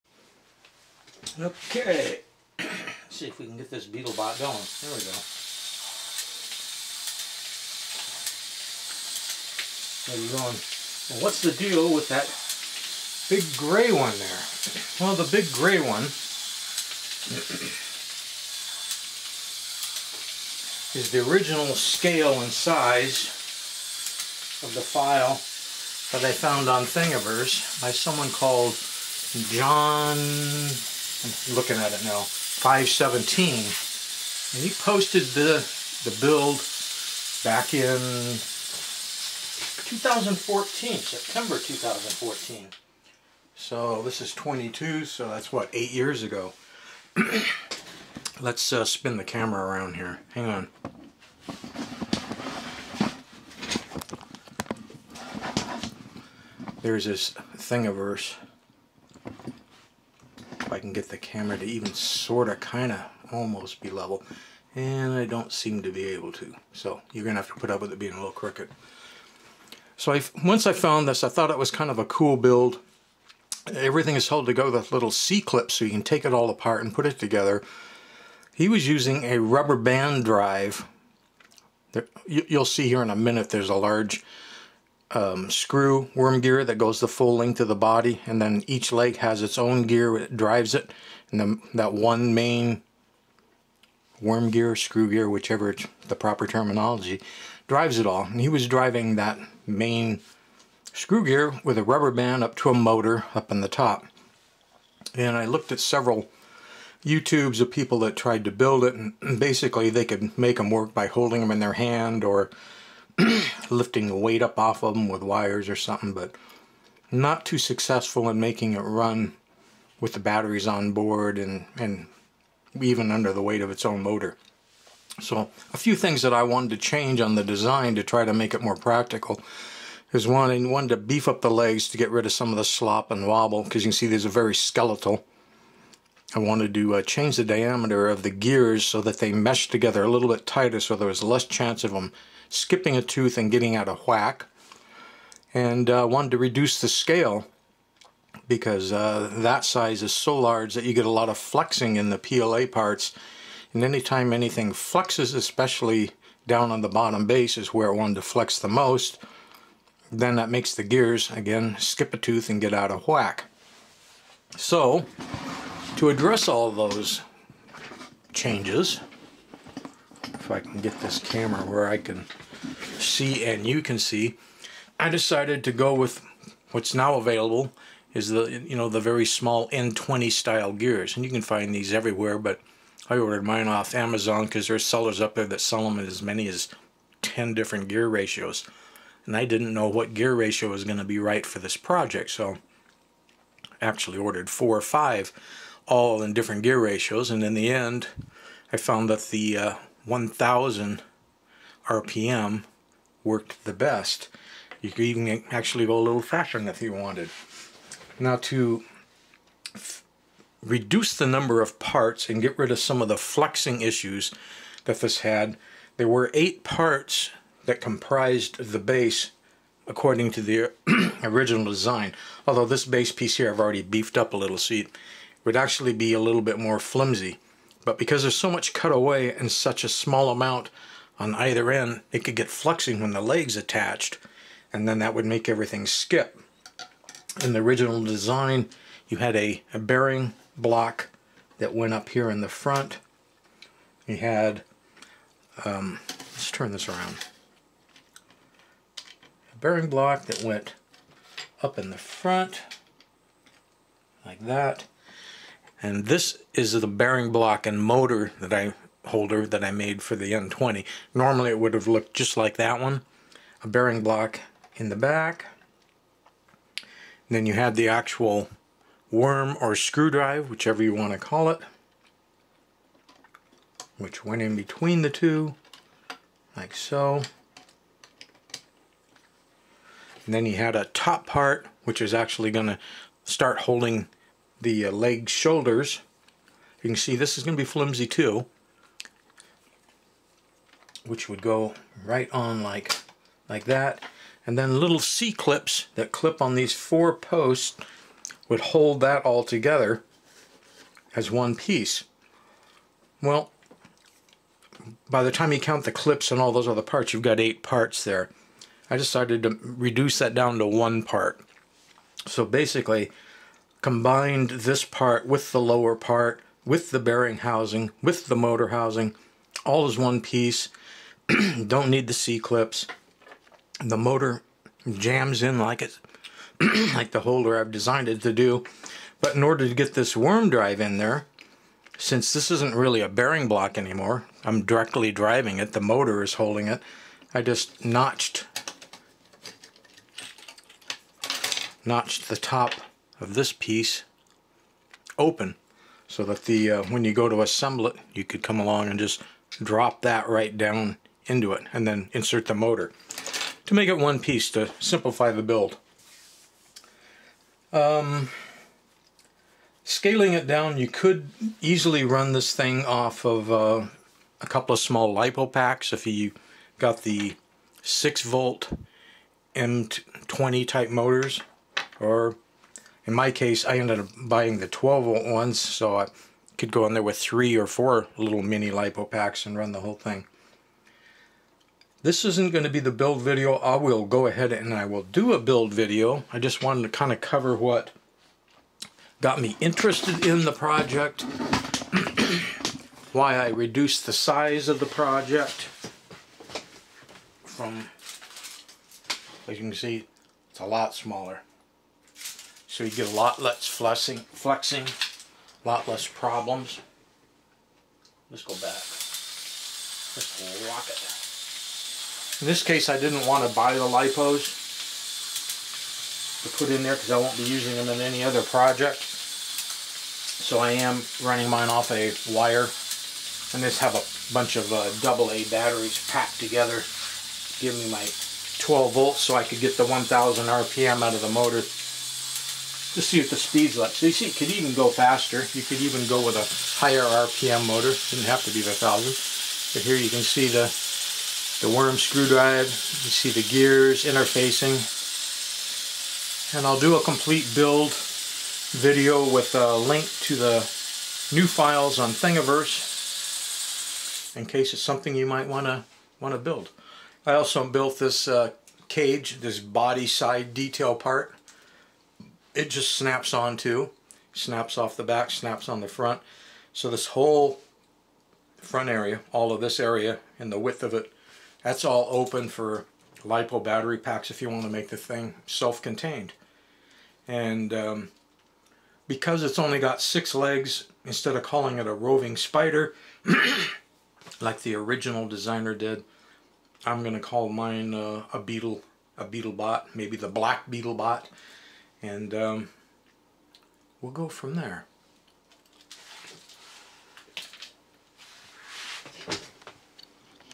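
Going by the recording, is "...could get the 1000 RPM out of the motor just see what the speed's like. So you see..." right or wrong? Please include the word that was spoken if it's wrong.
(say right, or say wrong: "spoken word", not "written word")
right.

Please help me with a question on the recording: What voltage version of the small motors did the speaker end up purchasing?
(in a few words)
12 volt.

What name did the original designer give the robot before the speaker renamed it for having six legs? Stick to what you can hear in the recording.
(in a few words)
roving spider.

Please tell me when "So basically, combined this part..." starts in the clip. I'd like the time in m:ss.
5:12.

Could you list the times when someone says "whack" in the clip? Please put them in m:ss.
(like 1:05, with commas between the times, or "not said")
2:24, 2:43.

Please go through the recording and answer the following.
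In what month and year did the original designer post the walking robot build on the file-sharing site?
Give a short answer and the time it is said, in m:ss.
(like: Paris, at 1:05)
September 2014, at 0:40.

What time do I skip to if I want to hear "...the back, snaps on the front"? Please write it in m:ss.
7:44.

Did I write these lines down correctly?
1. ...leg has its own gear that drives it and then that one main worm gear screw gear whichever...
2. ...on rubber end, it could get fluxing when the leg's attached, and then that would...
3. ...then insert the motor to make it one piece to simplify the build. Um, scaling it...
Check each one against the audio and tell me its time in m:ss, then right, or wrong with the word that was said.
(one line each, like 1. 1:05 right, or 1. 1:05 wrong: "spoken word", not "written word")
1. 1:28 right
2. 3:51 wrong: "either", not "rubber"
3. 5:51 right.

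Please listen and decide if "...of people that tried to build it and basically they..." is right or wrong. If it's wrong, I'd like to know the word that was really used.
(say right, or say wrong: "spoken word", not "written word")
right.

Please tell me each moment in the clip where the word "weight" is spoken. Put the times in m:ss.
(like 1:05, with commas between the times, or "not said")
1:54, 2:03.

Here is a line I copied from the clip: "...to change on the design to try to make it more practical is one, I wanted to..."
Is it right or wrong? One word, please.
right.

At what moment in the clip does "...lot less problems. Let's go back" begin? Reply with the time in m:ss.
6:45.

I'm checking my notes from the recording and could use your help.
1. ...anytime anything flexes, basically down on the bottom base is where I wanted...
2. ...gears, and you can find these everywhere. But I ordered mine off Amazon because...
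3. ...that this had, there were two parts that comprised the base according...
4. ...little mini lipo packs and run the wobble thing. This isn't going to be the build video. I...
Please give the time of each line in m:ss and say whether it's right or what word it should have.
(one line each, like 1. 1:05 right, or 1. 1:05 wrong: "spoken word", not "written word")
1. 2:33 wrong: "especially", not "basically"
2. 3:00 right
3. 3:34 wrong: "eight", not "two"
4. 6:18 wrong: "whole", not "wobble".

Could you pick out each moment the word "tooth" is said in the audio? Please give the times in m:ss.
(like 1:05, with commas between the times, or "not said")
2:23, 2:42.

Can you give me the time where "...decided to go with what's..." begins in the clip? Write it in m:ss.
2:55.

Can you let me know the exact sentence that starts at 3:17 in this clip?
And in the end, I found that the uh, 1000 RPM worked the best.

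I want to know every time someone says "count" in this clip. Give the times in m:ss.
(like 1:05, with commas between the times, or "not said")
5:05.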